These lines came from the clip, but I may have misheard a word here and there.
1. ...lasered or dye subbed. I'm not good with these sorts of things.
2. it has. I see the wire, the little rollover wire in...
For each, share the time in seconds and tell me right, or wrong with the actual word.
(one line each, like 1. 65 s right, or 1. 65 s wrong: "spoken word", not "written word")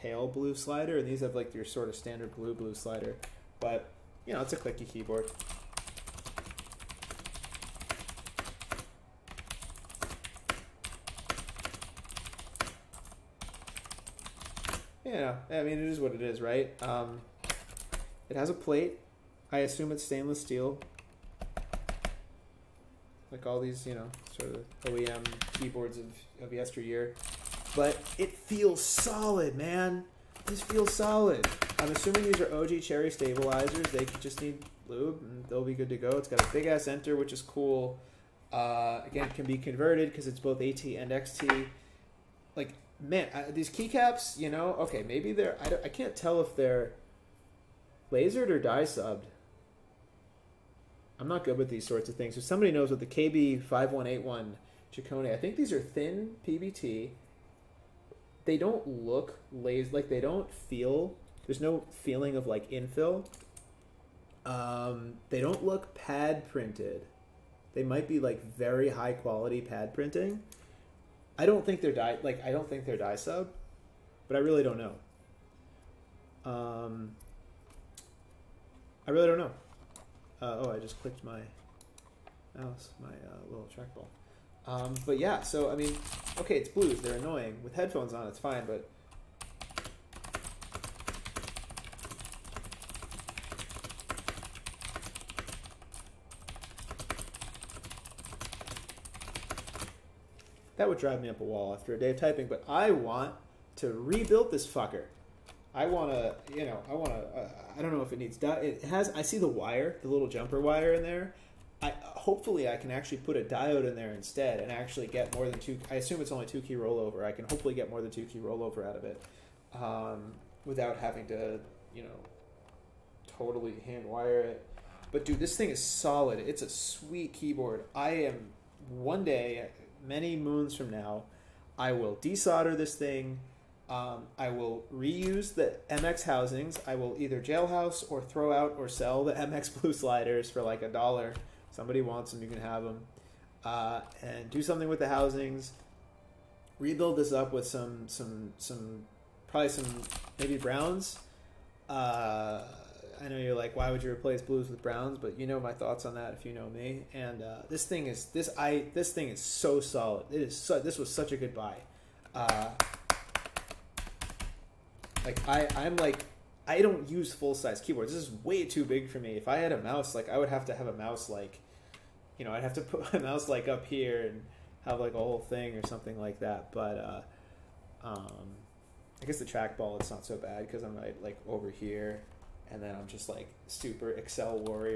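1. 48 s right
2. 108 s wrong: "jumper", not "rollover".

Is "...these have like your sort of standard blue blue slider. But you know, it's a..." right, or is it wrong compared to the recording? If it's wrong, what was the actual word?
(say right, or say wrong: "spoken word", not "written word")
right.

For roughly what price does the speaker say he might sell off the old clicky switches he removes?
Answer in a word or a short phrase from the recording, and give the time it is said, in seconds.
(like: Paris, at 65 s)
a dollar, at 140 s.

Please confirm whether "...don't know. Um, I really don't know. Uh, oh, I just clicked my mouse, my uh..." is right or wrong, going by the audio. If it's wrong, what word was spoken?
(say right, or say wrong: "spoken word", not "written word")
right.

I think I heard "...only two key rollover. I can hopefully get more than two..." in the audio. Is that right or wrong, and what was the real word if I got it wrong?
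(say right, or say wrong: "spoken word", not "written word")
right.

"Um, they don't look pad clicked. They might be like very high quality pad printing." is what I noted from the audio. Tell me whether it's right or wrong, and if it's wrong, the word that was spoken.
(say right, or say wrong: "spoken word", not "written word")
wrong: "printed", not "clicked".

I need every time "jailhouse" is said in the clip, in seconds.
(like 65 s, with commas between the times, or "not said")
137 s.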